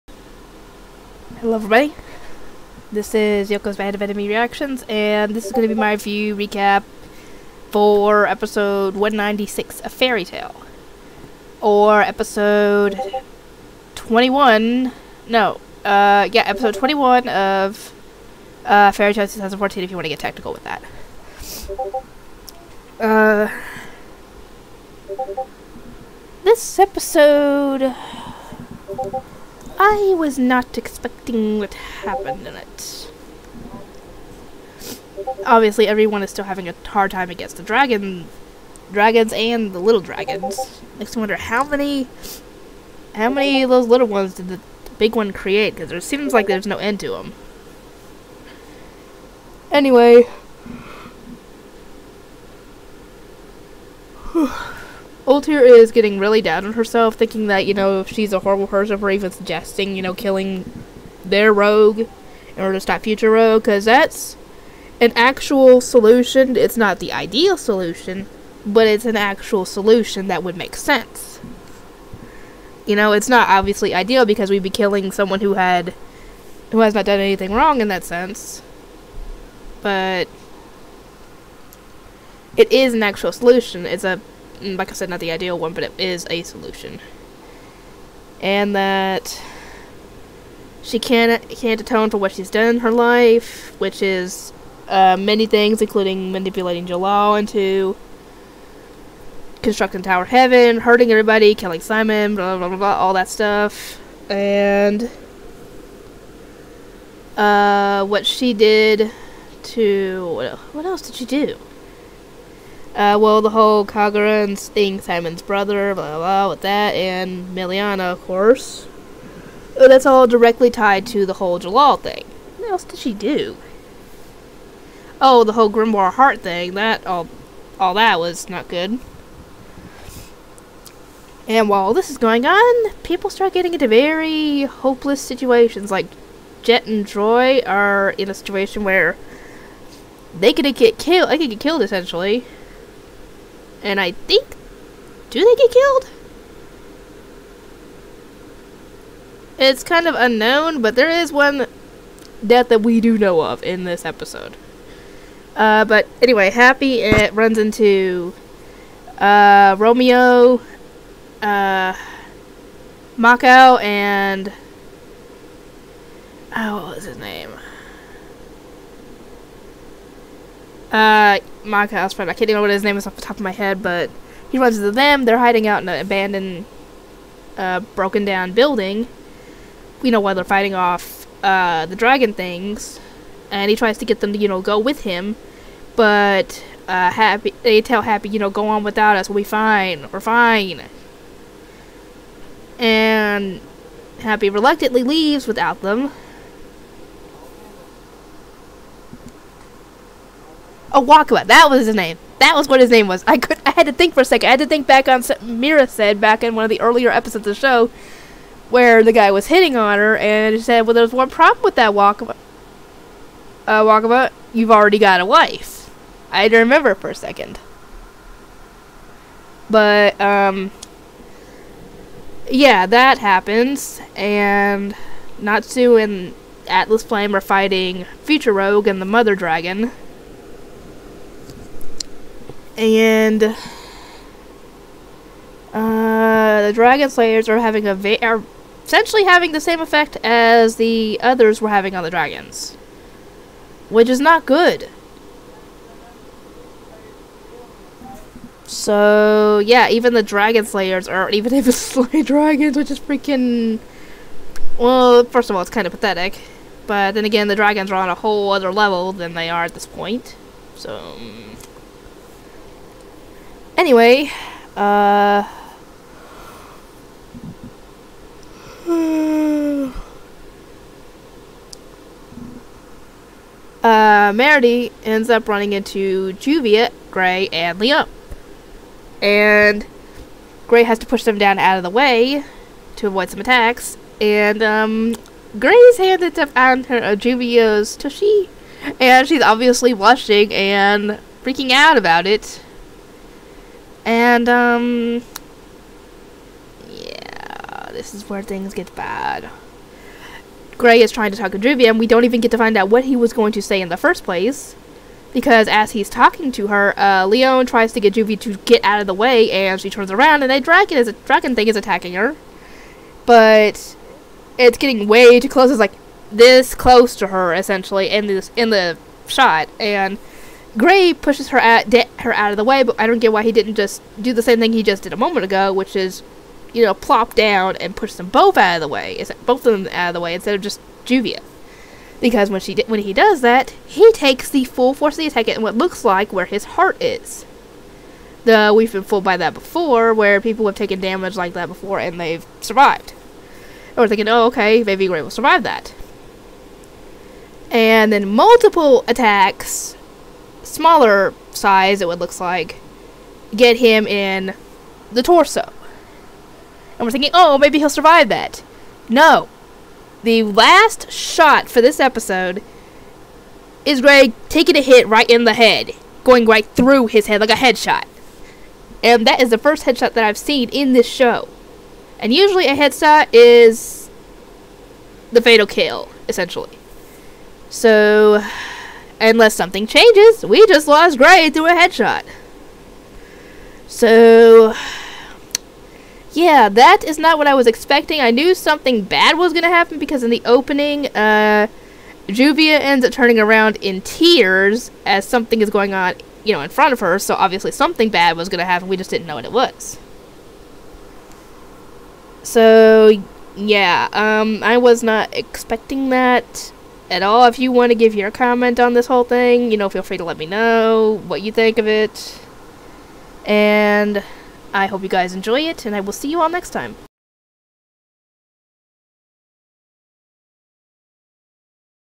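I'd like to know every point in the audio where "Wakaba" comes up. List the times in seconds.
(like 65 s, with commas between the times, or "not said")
201 s, 211 s.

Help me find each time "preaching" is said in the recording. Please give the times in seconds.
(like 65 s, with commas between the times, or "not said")
not said.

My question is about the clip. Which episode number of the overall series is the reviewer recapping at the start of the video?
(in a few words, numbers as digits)
196.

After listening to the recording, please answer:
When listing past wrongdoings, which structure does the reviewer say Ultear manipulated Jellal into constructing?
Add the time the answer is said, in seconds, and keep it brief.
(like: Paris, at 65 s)
Tower Heaven, at 100 s.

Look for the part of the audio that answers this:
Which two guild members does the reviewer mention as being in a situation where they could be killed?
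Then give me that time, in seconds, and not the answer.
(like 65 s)
136 s.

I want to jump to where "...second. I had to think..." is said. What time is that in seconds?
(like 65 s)
204 s.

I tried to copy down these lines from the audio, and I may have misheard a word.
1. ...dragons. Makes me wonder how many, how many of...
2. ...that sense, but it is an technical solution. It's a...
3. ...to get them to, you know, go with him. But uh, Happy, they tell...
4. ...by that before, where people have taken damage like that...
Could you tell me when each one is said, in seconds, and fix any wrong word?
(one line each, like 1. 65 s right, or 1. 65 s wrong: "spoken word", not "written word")
1. 40 s right
2. 77 s wrong: "actual", not "technical"
3. 183 s right
4. 339 s right.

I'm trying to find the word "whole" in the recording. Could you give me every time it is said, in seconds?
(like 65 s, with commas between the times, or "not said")
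113 s, 121 s, 125 s, 258 s, 409 s.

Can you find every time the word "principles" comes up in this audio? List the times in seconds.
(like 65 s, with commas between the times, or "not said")
not said.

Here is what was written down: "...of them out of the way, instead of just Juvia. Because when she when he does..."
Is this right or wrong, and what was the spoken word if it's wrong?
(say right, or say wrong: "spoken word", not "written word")
right.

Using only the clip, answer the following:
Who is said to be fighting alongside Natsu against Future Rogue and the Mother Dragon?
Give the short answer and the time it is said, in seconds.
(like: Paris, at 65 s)
Atlas Flame, at 226 s.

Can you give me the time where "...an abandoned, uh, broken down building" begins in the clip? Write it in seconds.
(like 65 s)
175 s.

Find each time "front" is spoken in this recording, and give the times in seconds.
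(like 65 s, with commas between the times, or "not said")
396 s.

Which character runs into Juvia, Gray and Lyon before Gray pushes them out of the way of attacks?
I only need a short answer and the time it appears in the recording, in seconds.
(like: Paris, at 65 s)
Meredy, at 274 s.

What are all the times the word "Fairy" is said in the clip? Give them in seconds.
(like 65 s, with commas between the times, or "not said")
9 s, 18 s.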